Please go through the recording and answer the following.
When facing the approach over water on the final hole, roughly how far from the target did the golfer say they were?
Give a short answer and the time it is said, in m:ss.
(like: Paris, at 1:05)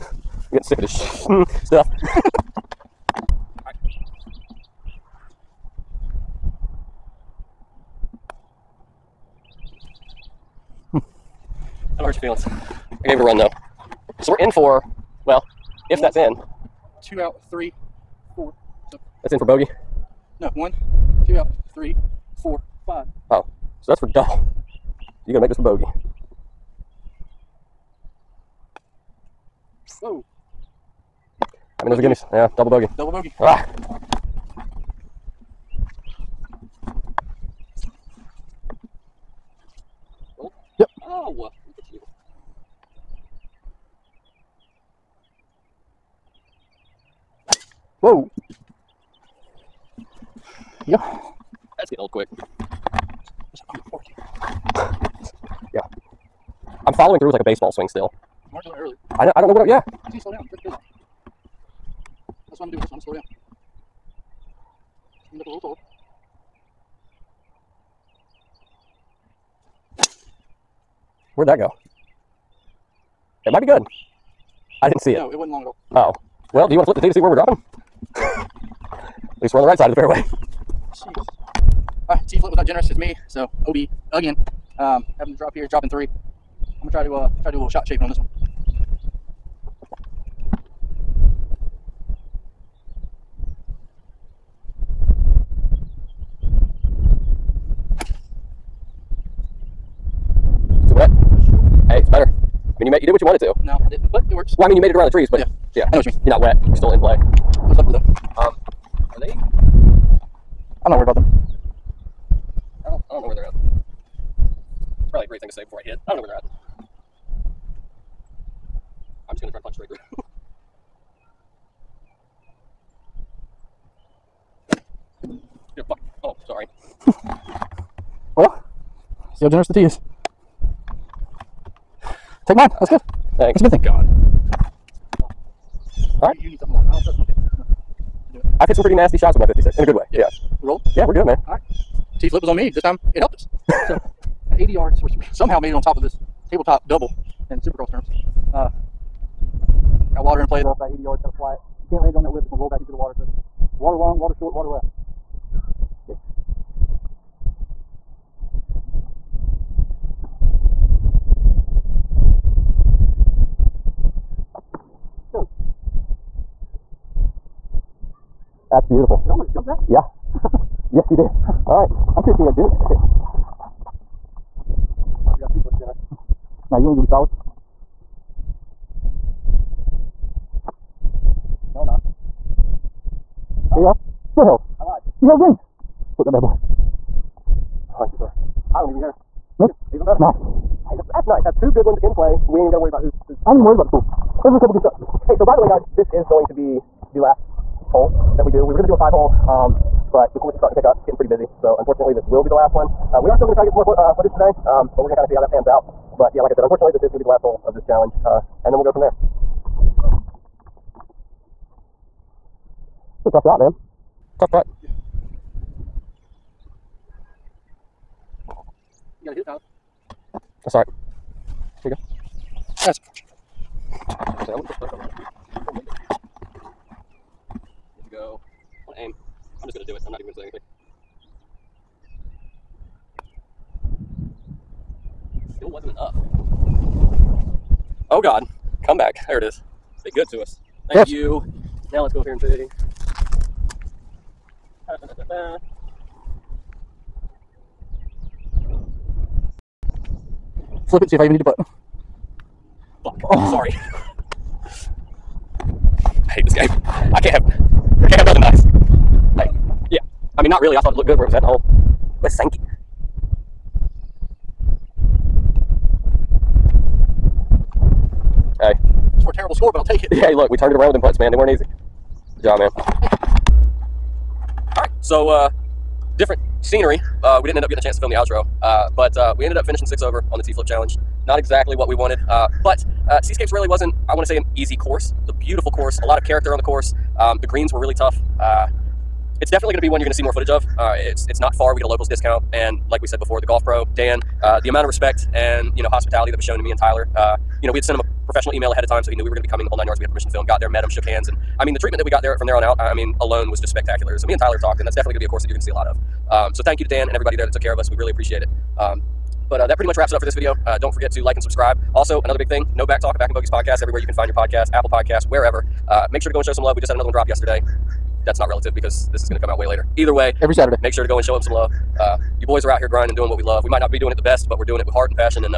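80 yards, at 2:24.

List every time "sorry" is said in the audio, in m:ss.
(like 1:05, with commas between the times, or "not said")
2:06, 4:13.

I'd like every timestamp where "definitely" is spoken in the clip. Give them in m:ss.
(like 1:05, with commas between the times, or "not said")
4:49, 5:04.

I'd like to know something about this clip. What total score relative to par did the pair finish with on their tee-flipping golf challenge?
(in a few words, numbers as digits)
6 over.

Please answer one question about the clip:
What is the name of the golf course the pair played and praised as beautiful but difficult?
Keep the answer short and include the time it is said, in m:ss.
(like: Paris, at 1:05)
Seascapes, at 4:43.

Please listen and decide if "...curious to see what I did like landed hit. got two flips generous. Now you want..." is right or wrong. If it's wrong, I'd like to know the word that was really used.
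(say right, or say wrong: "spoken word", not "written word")
right.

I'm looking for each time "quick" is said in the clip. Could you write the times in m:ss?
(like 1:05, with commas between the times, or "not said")
0:52.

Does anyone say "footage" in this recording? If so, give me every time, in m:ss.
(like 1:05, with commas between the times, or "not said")
3:24, 4:50.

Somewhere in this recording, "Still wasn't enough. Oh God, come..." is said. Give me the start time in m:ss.
3:55.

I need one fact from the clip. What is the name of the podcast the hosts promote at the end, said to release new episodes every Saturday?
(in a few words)
No Back Talk.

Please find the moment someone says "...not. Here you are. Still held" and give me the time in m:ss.
3:01.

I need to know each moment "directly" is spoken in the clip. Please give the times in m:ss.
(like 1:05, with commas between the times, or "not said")
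not said.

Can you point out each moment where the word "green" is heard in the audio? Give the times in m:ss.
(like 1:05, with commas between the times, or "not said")
3:05, 4:47.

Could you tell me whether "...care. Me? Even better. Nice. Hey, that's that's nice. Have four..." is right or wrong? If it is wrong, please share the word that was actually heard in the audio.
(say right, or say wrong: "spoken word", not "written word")
wrong: "two", not "four".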